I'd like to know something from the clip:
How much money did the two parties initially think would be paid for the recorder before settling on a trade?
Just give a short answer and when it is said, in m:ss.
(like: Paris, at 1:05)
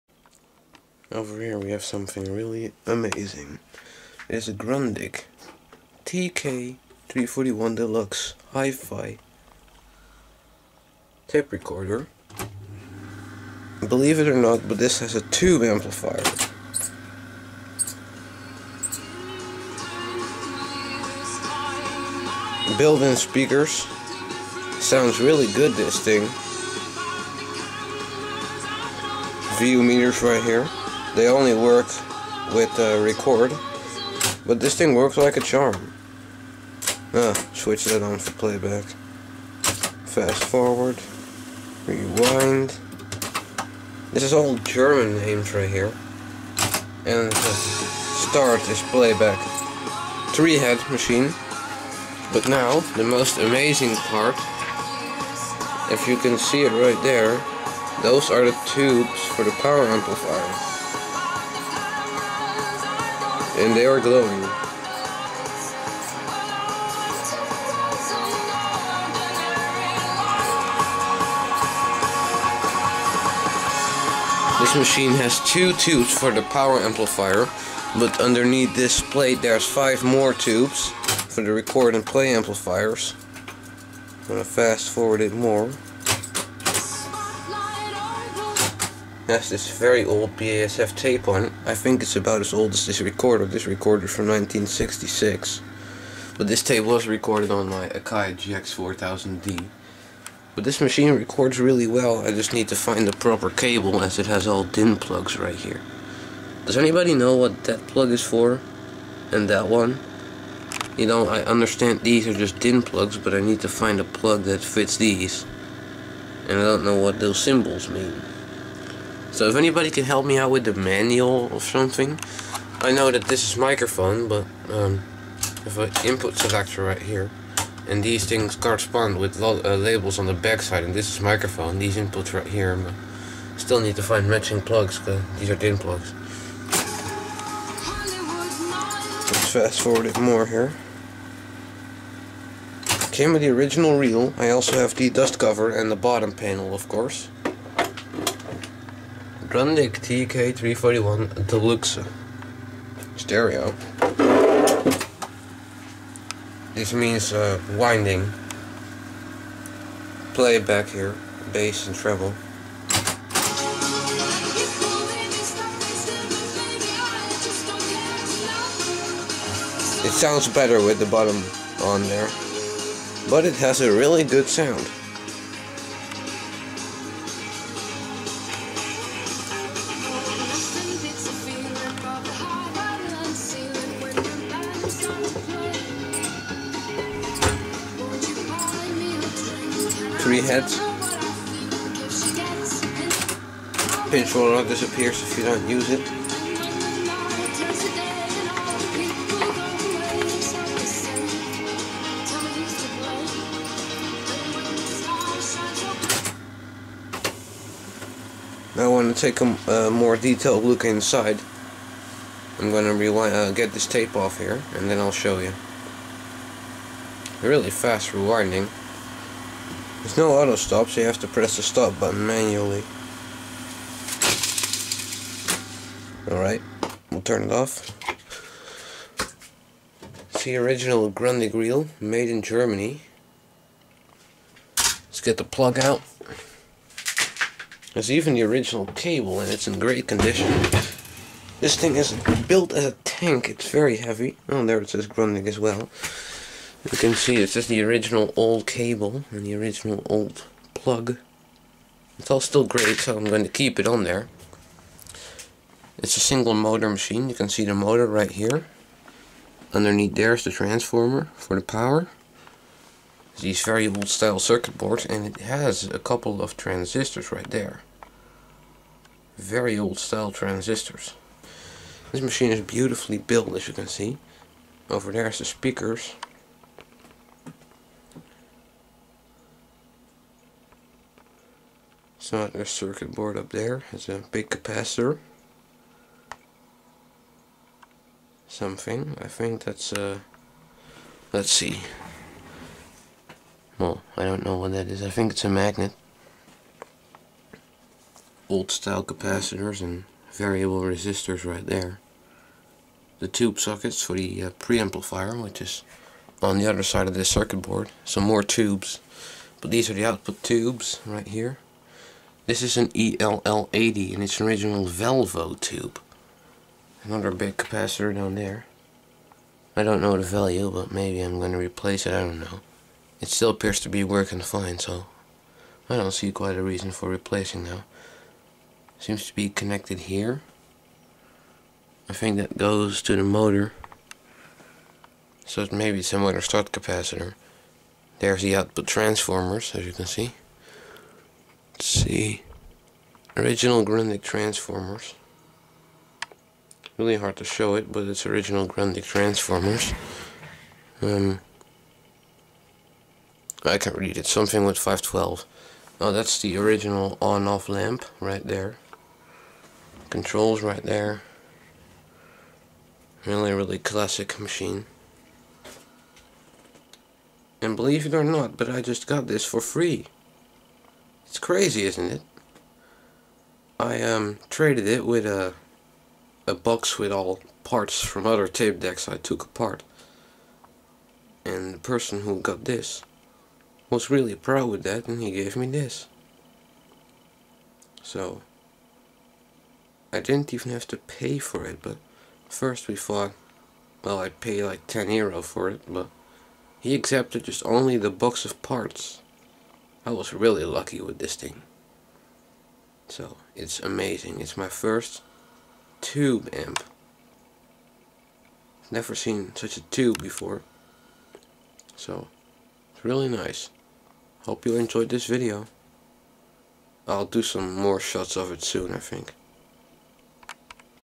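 10 euro, at 6:34.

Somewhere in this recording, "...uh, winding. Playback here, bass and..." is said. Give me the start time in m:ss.
2:37.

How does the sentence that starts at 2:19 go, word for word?
Let's fast forward it more here.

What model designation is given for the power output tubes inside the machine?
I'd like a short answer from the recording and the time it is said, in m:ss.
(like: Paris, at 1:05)
ELL80, at 5:12.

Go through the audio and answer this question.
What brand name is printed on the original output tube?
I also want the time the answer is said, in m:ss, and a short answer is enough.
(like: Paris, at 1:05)
Valvo, at 5:14.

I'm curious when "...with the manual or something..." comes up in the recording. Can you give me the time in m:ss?
2:00.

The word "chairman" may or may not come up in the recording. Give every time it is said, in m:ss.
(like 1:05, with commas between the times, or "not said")
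not said.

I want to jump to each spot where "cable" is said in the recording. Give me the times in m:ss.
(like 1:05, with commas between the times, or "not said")
1:43, 3:58, 4:08.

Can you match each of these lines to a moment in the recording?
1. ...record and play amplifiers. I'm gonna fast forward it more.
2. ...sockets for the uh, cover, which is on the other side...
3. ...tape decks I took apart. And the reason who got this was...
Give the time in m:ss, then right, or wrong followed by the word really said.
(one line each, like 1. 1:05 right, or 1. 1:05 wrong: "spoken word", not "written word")
1. 1:21 right
2. 5:03 wrong: "preamplifier", not "cover"
3. 6:18 wrong: "person", not "reason".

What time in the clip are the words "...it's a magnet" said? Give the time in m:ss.
4:55.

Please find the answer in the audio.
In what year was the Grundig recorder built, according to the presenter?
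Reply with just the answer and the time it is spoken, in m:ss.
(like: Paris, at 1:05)
1966, at 1:34.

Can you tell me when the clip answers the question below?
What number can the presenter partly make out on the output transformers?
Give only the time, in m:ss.
5:54.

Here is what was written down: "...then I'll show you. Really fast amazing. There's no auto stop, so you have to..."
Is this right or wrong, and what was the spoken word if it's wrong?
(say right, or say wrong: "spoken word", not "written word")
wrong: "rewinding", not "amazing".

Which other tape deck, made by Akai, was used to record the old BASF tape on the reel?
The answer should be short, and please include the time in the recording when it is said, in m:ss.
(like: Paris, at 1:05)
Akai GX4000D, at 1:37.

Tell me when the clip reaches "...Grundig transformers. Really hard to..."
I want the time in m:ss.
5:43.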